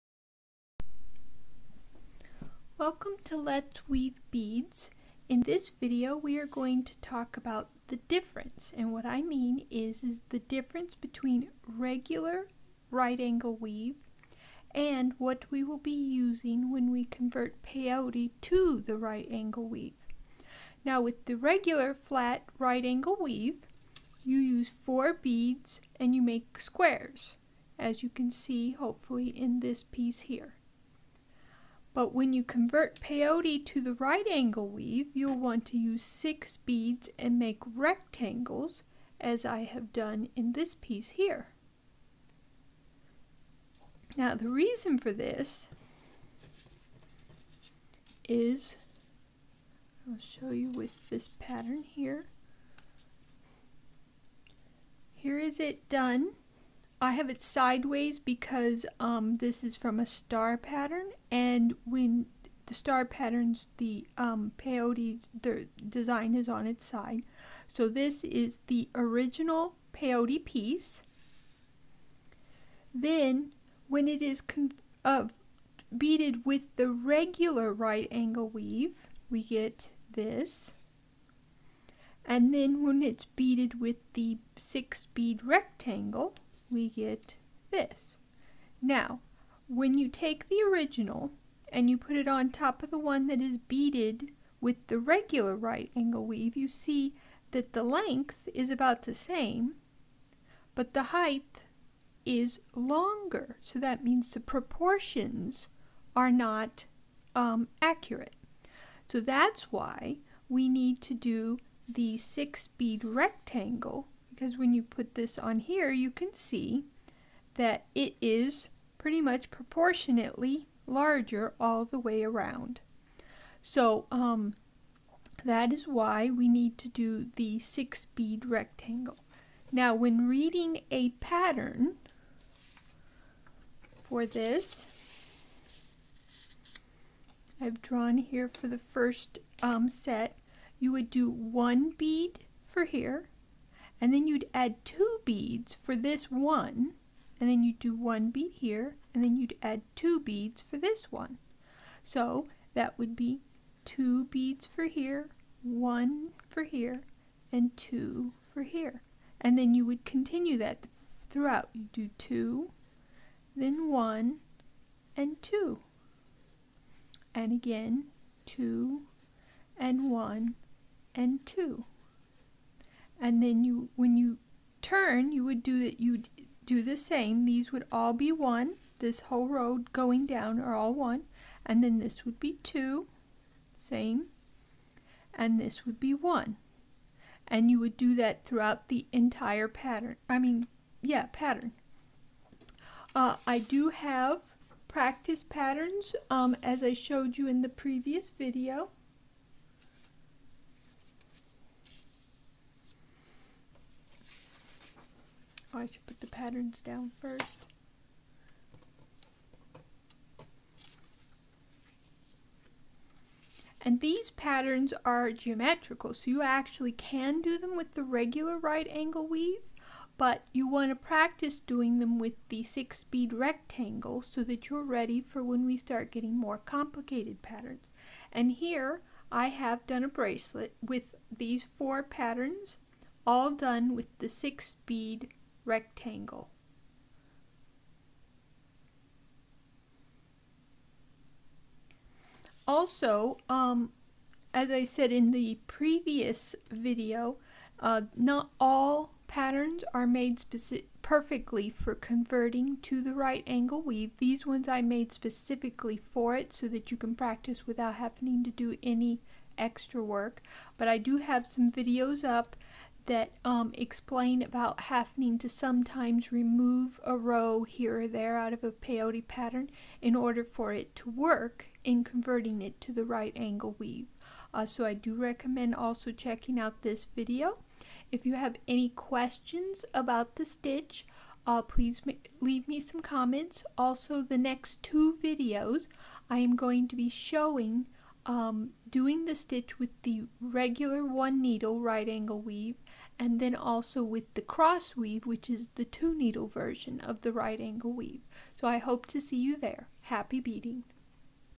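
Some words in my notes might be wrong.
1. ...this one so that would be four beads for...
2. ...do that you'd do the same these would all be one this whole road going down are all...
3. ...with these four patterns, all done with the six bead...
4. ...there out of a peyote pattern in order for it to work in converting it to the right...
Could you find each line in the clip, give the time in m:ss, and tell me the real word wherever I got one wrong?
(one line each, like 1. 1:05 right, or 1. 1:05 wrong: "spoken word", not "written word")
1. 2:30 wrong: "two", not "four"
2. 2:55 right
3. 3:50 right
4. 4:28 right.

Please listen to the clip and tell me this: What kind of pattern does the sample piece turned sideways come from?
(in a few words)
Star pattern.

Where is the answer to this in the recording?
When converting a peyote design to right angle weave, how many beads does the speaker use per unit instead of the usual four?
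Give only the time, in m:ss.
0:36.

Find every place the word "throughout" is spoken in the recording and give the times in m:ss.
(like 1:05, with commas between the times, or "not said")
2:41, 3:08.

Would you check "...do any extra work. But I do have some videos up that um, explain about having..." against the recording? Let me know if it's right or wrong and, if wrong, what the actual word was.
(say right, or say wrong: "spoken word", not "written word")
right.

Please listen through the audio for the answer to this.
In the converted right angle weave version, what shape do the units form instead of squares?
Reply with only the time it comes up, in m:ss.
0:37.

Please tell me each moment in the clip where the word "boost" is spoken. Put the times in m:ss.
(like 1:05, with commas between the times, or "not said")
not said.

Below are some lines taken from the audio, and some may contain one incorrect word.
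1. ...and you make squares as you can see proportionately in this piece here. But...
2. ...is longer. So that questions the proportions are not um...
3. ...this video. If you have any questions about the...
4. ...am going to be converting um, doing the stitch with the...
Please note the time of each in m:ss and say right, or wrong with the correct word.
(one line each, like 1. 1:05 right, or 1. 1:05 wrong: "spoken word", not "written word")
1. 0:25 wrong: "hopefully", not "proportionately"
2. 1:42 wrong: "means", not "questions"
3. 4:36 right
4. 4:46 wrong: "showing", not "converting".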